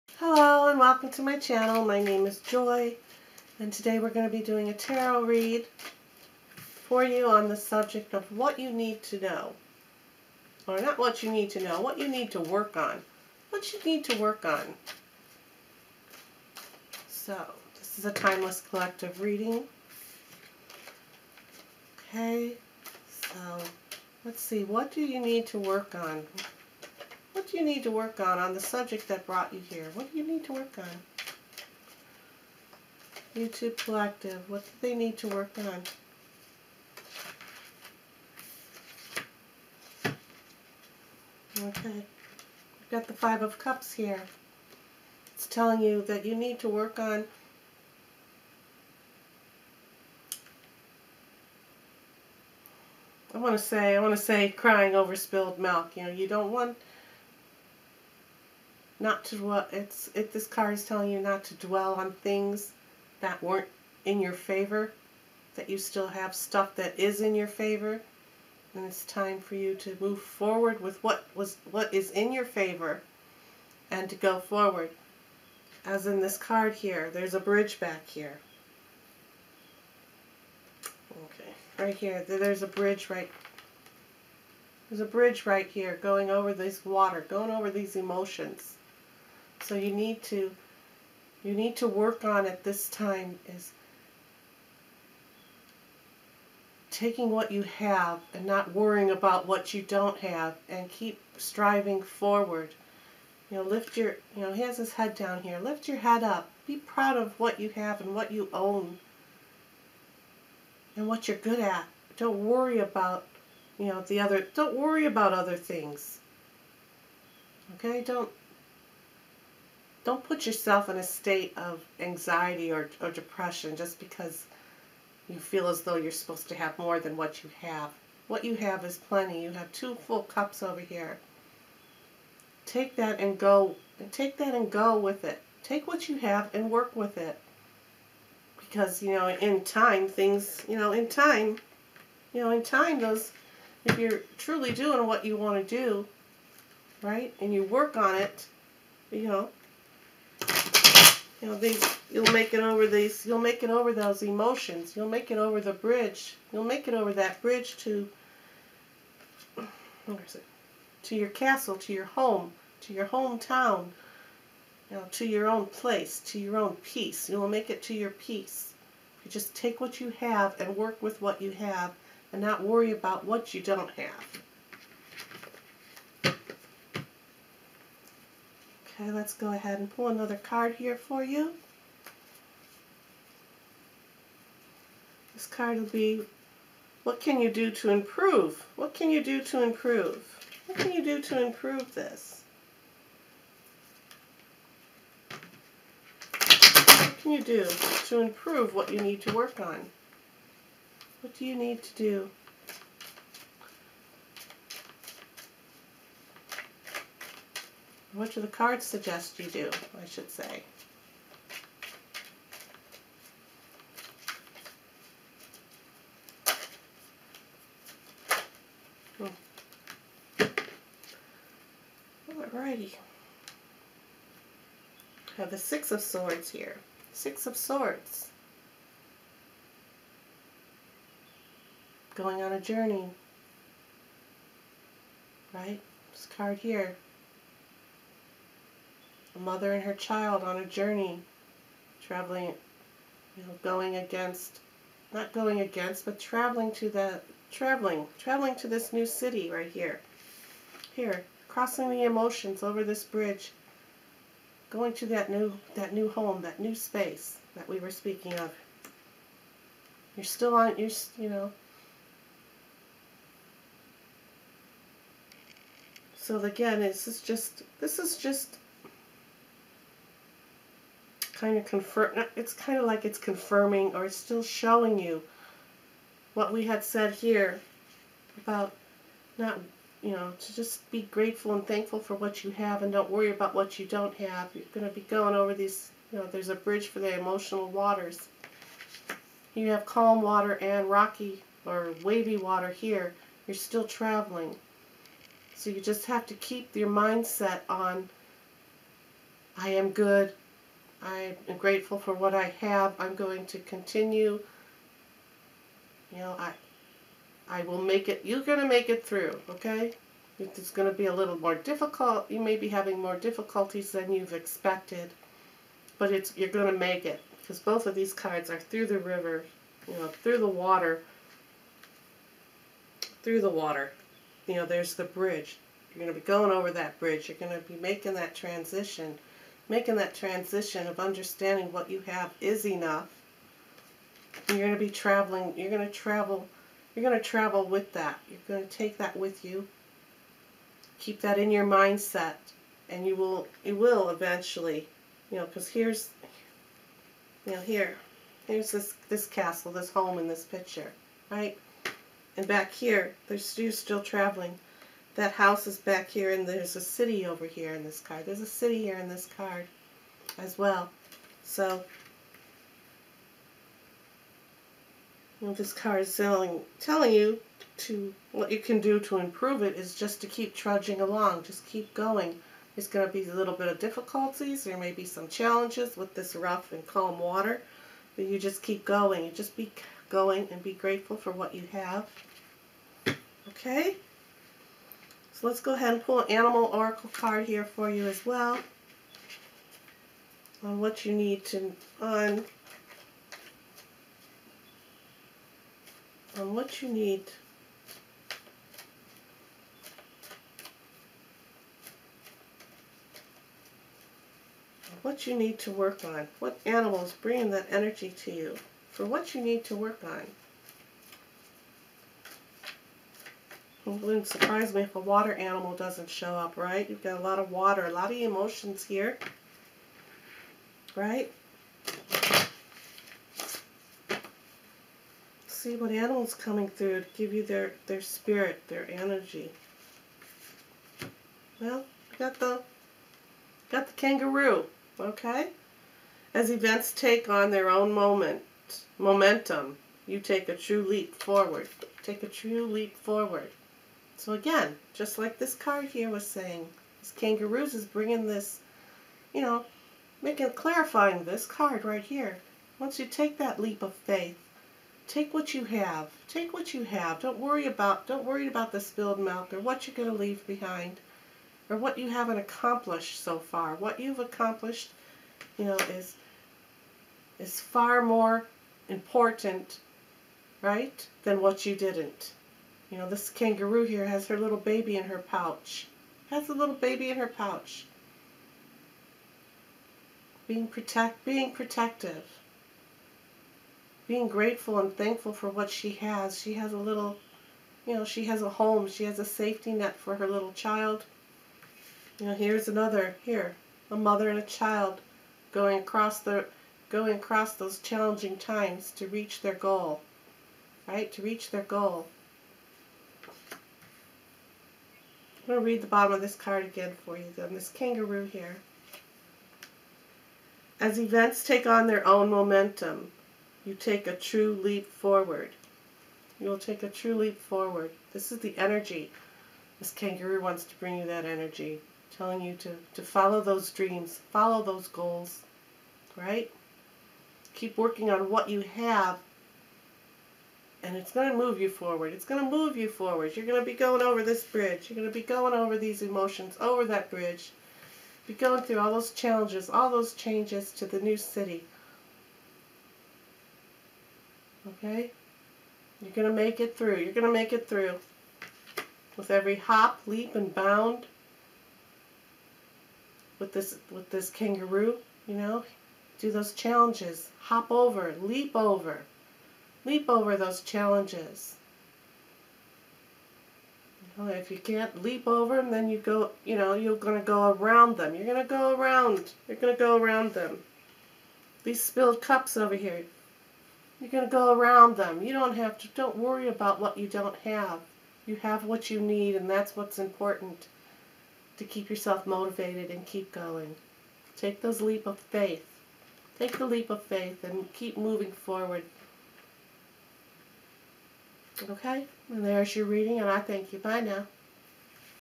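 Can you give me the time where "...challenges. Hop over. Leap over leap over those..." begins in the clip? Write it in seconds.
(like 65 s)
556 s.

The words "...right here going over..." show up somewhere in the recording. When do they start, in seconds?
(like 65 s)
85 s.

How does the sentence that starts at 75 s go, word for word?
As in this card here, there's a bridge back here.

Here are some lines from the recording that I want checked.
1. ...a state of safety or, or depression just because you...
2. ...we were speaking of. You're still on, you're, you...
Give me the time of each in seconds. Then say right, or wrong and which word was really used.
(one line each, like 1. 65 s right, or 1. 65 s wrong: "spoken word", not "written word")
1. 120 s wrong: "anxiety", not "safety"
2. 257 s right.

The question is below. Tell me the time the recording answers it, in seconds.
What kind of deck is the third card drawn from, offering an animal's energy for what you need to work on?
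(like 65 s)
386 s.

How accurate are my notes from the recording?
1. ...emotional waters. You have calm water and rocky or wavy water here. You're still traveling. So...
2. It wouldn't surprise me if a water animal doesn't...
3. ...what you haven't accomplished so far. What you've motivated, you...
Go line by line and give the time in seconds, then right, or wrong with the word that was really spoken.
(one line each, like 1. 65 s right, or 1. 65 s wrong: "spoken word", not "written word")
1. 287 s right
2. 413 s right
3. 461 s wrong: "accomplished", not "motivated".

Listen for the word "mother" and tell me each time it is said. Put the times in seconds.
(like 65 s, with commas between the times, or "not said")
239 s, 493 s.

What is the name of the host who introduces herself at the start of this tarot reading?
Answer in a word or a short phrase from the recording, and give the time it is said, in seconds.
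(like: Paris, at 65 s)
Joy, at 2 s.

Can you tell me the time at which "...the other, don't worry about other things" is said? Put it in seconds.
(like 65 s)
114 s.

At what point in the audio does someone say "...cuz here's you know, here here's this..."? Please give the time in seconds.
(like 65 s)
345 s.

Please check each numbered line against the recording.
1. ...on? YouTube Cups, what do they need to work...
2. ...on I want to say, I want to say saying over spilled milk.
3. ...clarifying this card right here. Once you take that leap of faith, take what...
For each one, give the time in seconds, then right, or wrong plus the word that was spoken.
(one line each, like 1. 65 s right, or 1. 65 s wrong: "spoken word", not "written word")
1. 30 s wrong: "Collective", not "Cups"
2. 46 s wrong: "crying", not "saying"
3. 450 s right.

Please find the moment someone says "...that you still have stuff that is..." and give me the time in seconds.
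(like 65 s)
65 s.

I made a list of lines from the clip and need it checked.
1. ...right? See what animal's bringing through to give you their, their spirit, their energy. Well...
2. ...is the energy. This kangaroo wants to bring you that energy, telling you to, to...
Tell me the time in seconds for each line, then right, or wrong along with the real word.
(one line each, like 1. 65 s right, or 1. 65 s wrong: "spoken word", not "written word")
1. 420 s wrong: "coming", not "bringing"
2. 518 s right.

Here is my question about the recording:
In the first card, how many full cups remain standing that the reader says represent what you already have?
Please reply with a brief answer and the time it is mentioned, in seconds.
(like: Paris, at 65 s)
2, at 129 s.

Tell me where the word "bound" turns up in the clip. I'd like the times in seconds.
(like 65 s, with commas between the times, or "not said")
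550 s.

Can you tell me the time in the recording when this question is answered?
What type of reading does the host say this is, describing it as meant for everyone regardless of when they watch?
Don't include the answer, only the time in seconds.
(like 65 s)
18 s.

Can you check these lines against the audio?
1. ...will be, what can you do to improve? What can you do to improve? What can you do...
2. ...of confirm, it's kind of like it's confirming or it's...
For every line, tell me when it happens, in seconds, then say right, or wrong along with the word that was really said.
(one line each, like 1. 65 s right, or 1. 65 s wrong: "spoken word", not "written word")
1. 185 s right
2. 271 s right.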